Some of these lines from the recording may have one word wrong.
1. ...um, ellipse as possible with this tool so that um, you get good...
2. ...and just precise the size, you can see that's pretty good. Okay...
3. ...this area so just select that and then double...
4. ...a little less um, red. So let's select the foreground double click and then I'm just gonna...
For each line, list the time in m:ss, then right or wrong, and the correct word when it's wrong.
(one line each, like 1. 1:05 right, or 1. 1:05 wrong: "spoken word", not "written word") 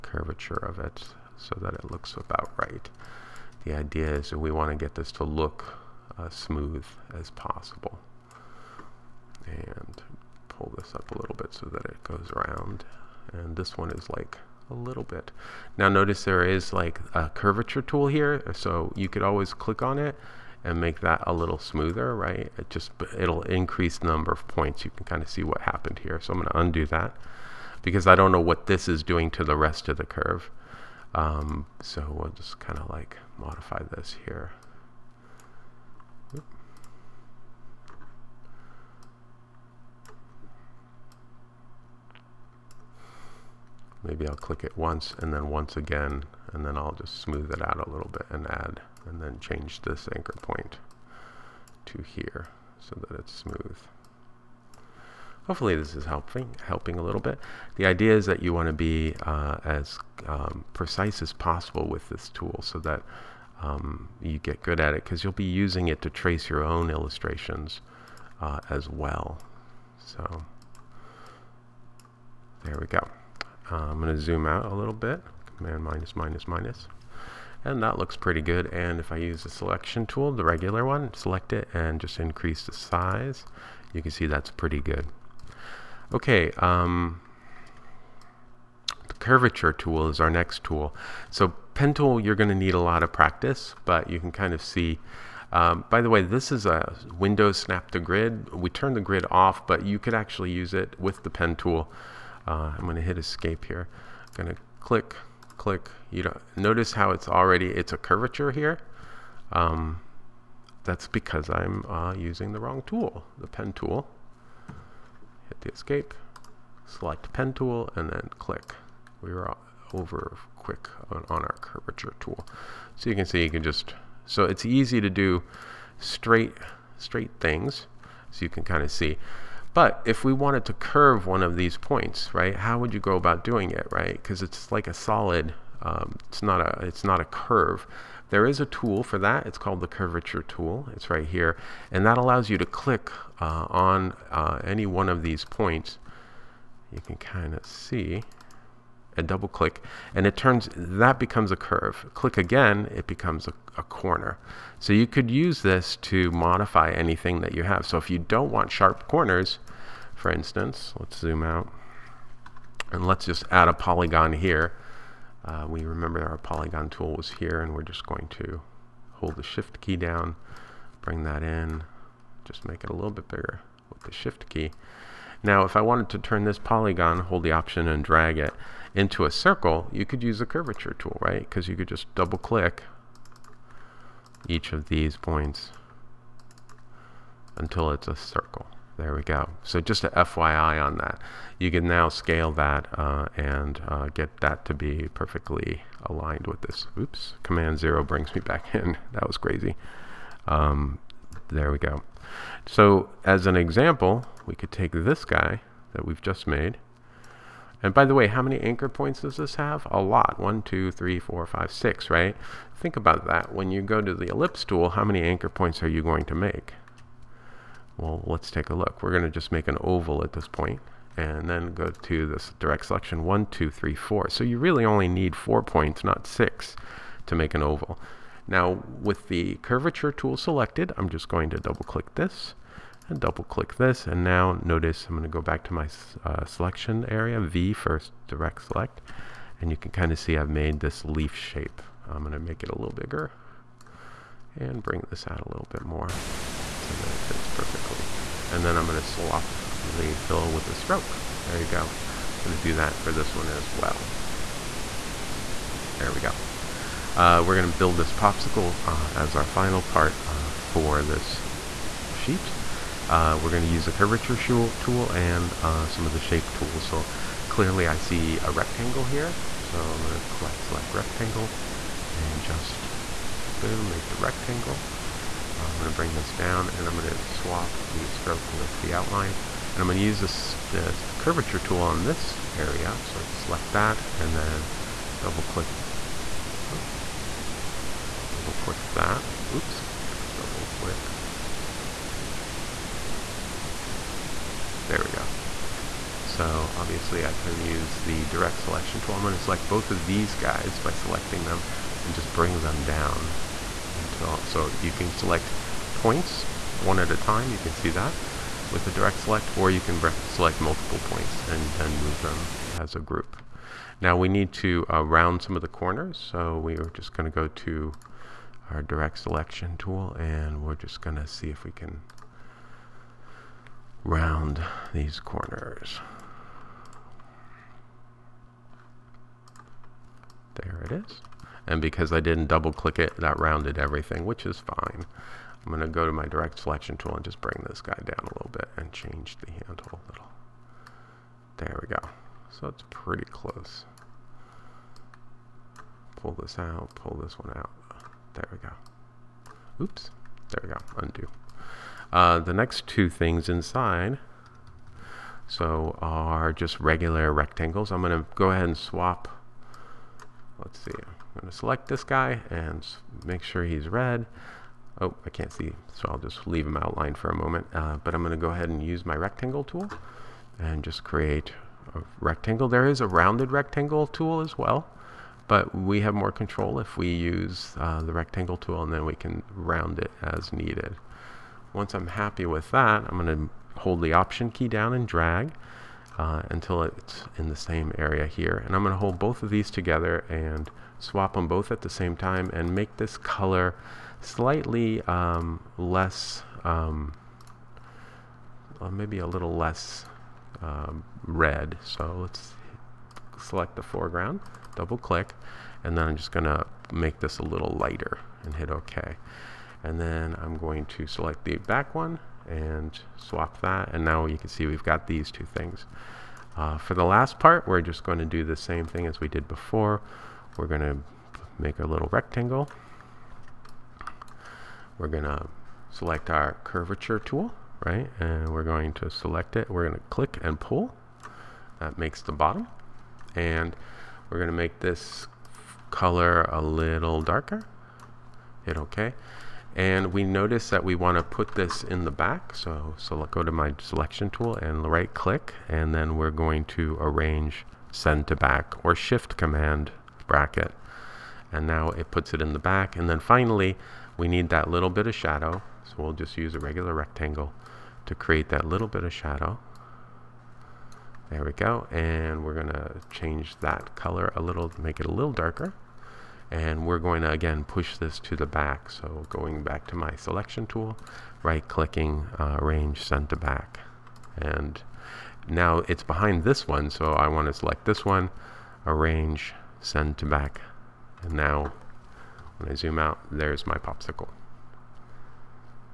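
1. 1:00 wrong: "precise", not "ellipse"
2. 1:21 wrong: "increase", not "precise"
3. 4:42 right
4. 6:39 right.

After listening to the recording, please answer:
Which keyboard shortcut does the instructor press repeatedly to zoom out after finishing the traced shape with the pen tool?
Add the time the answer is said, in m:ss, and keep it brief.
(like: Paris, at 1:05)
Command minus, at 1:15.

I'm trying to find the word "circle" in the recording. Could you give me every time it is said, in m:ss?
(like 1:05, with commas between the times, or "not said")
2:59, 3:08.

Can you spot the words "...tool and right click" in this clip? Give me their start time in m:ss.
7:24.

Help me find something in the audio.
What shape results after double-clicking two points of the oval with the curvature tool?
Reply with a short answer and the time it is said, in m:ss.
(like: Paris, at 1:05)
leaf shape, at 4:01.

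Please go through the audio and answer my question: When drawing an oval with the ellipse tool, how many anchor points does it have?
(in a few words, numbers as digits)
4.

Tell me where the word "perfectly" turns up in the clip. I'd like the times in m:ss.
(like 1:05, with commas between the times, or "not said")
3:15, 4:07.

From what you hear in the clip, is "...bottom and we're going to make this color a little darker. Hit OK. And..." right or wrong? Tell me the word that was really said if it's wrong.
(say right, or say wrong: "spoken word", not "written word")
right.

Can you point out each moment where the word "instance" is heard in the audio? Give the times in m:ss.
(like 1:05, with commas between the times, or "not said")
2:40.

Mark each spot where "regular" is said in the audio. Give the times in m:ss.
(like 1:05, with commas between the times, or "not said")
1:20, 5:56, 7:36.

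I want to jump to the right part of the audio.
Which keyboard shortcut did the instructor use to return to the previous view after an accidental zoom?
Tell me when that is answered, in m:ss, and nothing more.
3:17.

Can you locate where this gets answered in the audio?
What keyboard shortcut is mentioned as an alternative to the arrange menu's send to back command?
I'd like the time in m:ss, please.
7:28.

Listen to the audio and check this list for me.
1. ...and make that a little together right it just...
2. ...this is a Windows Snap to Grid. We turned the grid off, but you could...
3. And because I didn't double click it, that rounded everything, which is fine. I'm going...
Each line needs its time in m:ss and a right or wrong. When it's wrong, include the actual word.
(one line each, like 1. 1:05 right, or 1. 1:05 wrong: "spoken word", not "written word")
1. 0:20 wrong: "smoother", not "together"
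2. 1:36 right
3. 5:31 right.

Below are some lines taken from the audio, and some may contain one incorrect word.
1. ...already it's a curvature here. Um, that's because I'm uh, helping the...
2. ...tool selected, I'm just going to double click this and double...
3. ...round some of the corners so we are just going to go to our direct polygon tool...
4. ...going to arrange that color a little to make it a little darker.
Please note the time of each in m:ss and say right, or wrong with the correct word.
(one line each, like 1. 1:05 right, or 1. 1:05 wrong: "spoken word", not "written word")
1. 1:47 wrong: "using", not "helping"
2. 3:50 right
3. 5:15 wrong: "selection", not "polygon"
4. 7:42 wrong: "change", not "arrange".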